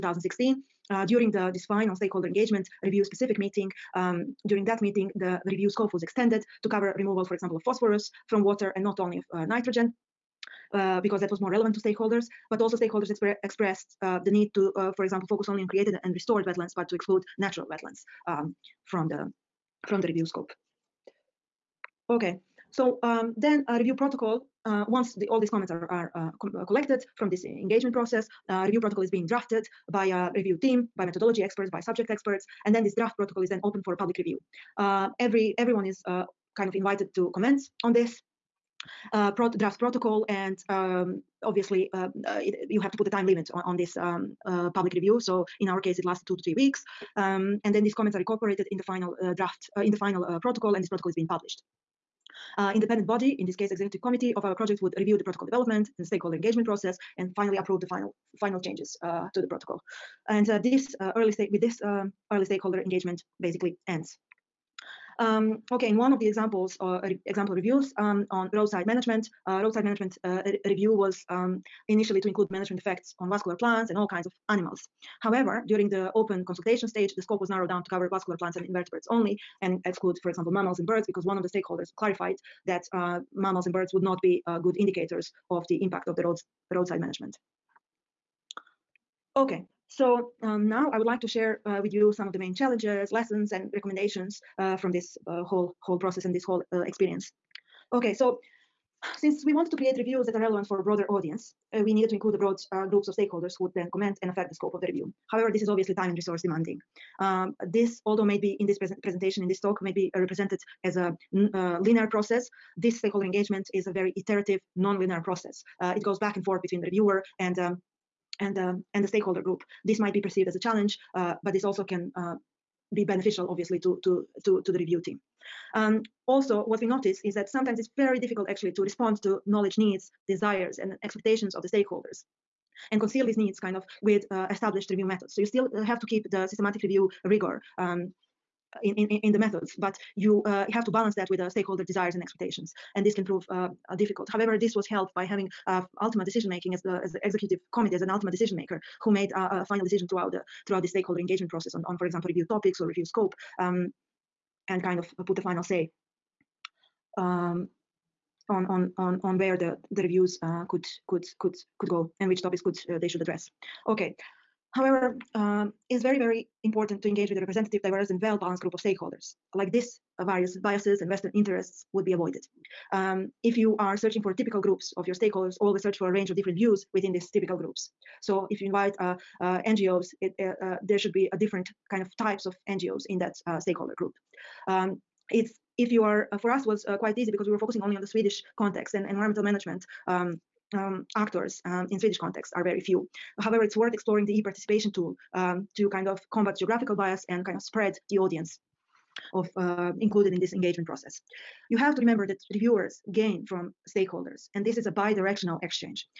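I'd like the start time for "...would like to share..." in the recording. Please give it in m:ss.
1:30.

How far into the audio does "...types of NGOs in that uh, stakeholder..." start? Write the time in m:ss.
3:02.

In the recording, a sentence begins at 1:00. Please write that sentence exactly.
And uh, this uh, early state with this um, early stakeholder engagement basically ends.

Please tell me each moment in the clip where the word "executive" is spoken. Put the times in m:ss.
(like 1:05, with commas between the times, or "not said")
0:53, 2:27.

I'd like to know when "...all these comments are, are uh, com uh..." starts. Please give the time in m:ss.
0:25.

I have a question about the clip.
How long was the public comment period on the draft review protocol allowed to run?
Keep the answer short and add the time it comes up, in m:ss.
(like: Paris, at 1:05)
2 to 3 weeks, at 0:46.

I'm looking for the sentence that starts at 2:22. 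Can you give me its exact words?
And this can prove uh, uh difficult.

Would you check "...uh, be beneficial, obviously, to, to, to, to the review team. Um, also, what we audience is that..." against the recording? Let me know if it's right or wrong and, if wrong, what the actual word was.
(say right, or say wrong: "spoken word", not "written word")
wrong: "notice", not "audience".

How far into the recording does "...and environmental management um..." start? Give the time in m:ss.
3:08.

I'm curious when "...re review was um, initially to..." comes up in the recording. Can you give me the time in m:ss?
1:10.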